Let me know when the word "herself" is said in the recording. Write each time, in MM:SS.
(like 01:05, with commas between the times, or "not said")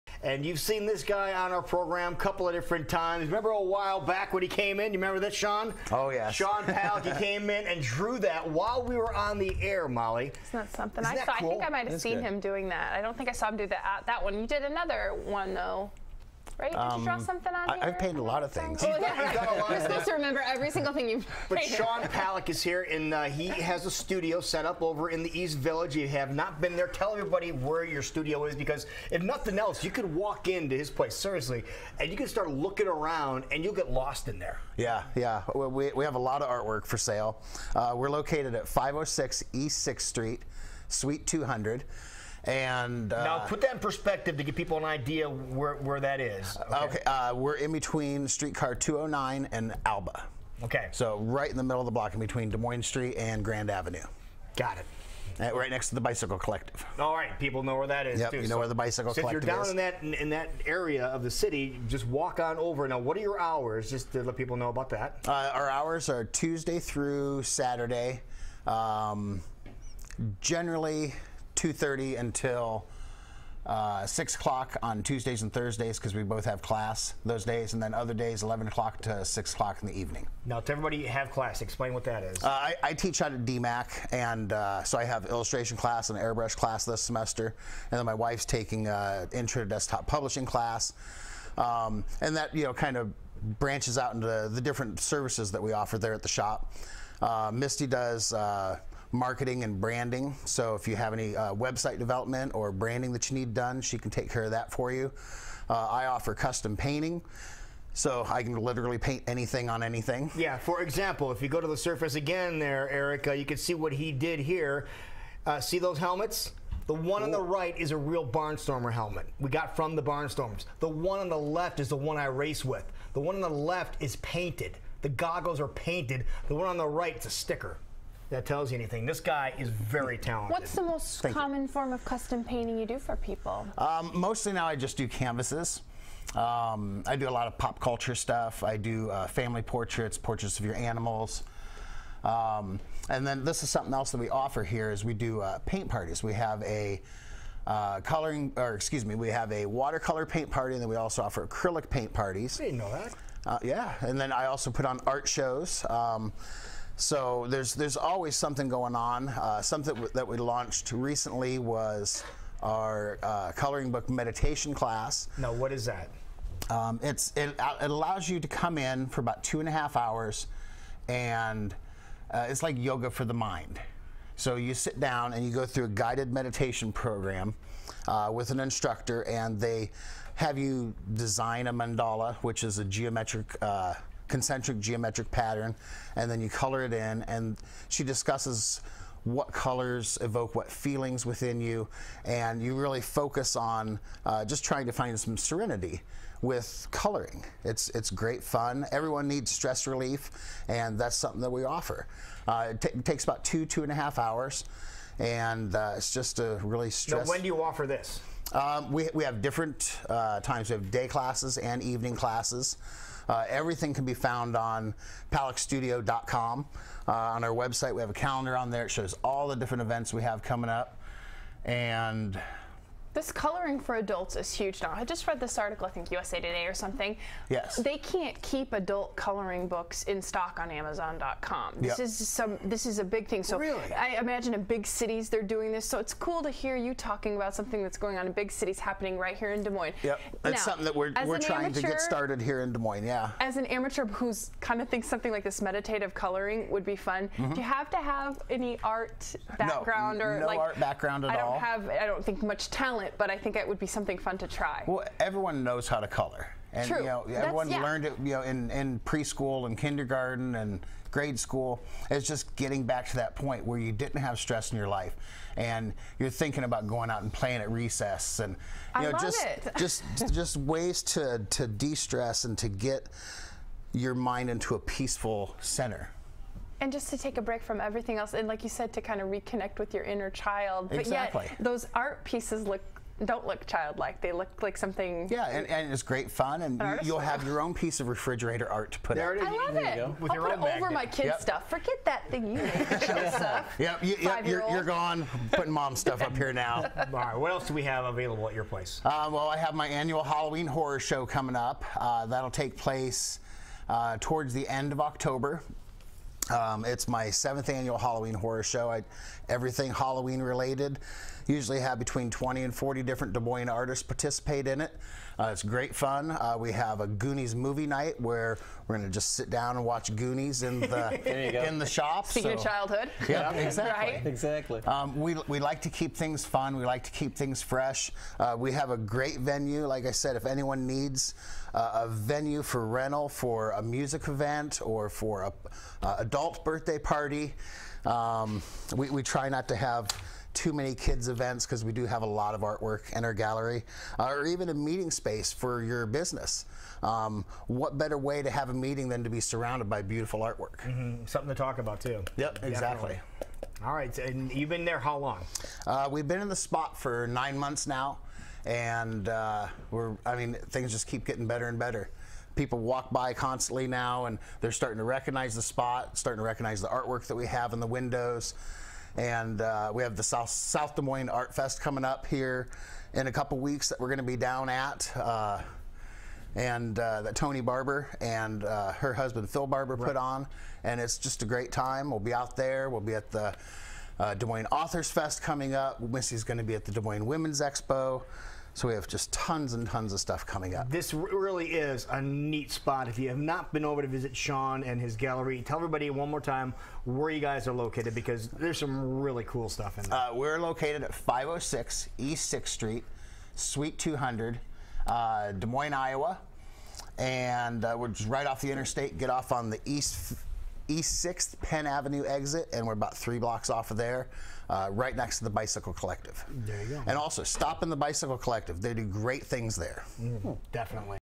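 not said.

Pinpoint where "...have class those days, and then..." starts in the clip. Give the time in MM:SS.
01:16.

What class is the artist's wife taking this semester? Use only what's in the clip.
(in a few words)
intro to desktop publishing.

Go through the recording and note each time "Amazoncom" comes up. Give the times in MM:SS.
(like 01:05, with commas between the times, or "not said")
03:50.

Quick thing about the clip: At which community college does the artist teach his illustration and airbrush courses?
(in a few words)
DMACC.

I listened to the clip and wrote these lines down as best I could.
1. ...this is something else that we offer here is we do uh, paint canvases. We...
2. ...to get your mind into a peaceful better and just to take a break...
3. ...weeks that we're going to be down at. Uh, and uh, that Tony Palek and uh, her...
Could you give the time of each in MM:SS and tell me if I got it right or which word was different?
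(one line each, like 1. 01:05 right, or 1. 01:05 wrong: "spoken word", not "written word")
1. 02:23 wrong: "parties", not "canvases"
2. 04:32 wrong: "center", not "better"
3. 06:13 wrong: "Barber", not "Palek".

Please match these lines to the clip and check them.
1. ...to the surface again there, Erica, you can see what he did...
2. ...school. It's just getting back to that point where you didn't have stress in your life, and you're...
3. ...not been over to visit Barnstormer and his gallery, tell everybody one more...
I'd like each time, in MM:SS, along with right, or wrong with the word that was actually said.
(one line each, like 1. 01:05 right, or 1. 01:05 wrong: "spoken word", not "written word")
1. 01:51 right
2. 04:21 right
3. 06:33 wrong: "Sean", not "Barnstormer".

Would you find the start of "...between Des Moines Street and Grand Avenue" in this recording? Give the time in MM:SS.
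00:52.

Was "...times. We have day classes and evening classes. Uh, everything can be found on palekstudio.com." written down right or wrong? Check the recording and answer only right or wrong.
right.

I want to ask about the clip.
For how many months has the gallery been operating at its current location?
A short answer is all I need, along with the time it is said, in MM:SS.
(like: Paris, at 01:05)
9, at 05:57.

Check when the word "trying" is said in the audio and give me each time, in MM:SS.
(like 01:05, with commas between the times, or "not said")
03:14, 04:01.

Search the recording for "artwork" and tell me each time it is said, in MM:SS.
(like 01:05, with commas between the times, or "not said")
00:36, 05:42, 05:50, 06:06.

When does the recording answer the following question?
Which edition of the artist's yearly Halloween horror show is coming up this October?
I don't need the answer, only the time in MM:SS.
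05:07.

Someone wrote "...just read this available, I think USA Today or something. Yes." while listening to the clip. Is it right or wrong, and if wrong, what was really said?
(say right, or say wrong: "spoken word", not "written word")
wrong: "article", not "available".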